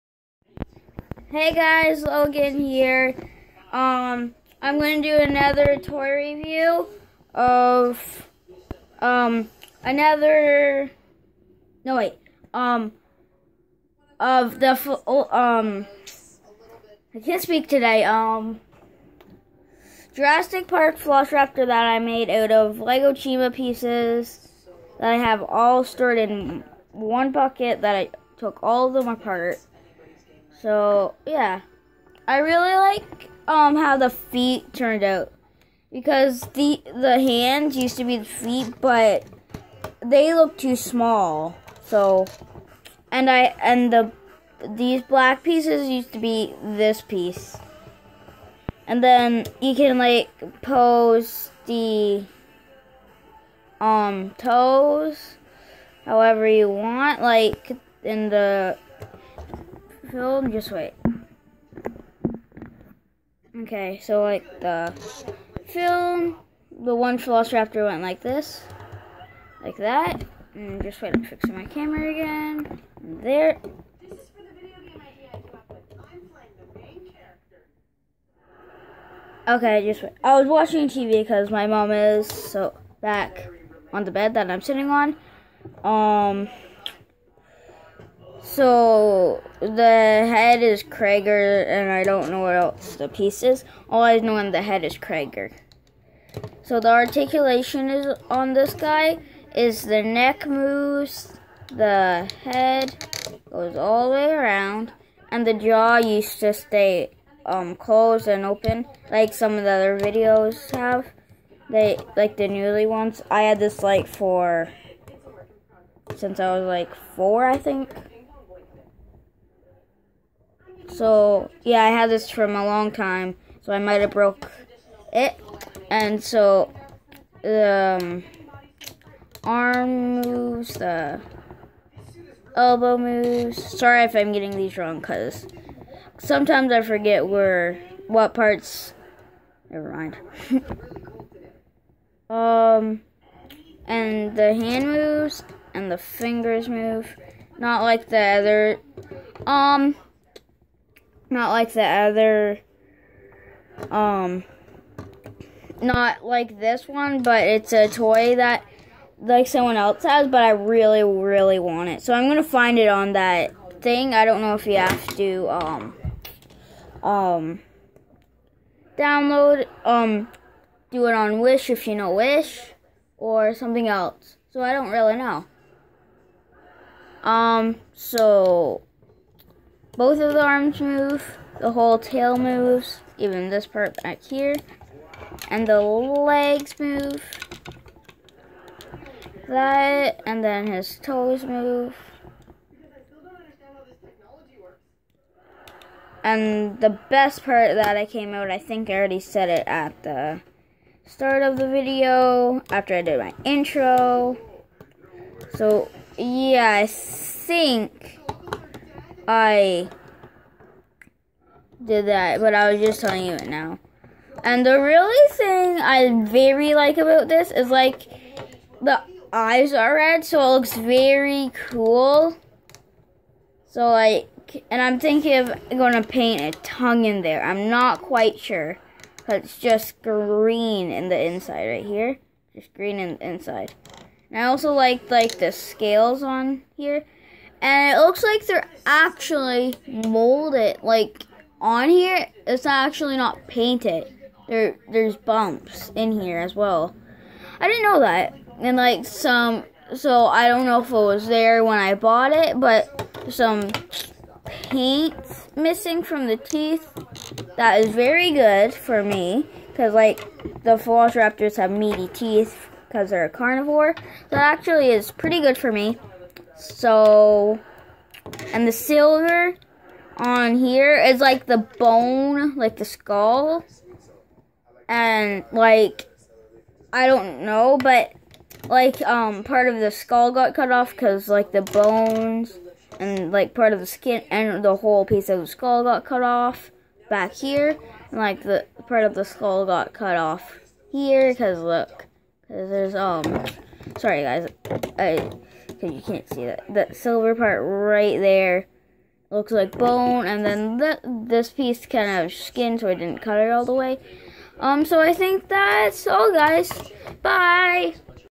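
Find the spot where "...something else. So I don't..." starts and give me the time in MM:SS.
02:53.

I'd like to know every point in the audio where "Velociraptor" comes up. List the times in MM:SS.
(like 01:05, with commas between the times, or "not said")
01:07, 04:20.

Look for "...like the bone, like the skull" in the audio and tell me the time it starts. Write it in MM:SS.
04:31.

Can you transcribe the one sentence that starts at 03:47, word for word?
I'm not quite sure, but it's just green in the inside right here, just green in the inside.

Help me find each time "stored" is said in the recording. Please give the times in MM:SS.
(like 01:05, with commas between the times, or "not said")
00:25.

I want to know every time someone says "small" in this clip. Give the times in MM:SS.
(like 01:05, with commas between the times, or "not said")
00:40.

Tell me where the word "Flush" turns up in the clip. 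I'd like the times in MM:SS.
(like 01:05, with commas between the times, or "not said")
00:20.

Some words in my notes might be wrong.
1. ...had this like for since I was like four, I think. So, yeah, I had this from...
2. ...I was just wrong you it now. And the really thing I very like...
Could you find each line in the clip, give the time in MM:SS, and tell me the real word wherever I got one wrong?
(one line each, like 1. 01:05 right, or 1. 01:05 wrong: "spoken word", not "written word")
1. 01:53 right
2. 03:32 wrong: "telling", not "wrong".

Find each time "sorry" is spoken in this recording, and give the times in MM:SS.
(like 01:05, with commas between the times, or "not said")
02:13, 04:53.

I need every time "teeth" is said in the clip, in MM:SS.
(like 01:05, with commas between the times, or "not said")
04:16, 04:22.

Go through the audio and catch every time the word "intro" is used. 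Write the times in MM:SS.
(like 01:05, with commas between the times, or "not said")
03:23.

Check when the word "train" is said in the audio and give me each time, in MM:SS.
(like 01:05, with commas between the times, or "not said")
not said.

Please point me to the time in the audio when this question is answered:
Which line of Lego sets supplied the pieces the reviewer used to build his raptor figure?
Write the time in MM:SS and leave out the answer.
00:22.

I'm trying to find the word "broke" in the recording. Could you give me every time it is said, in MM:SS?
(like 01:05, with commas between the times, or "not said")
02:04.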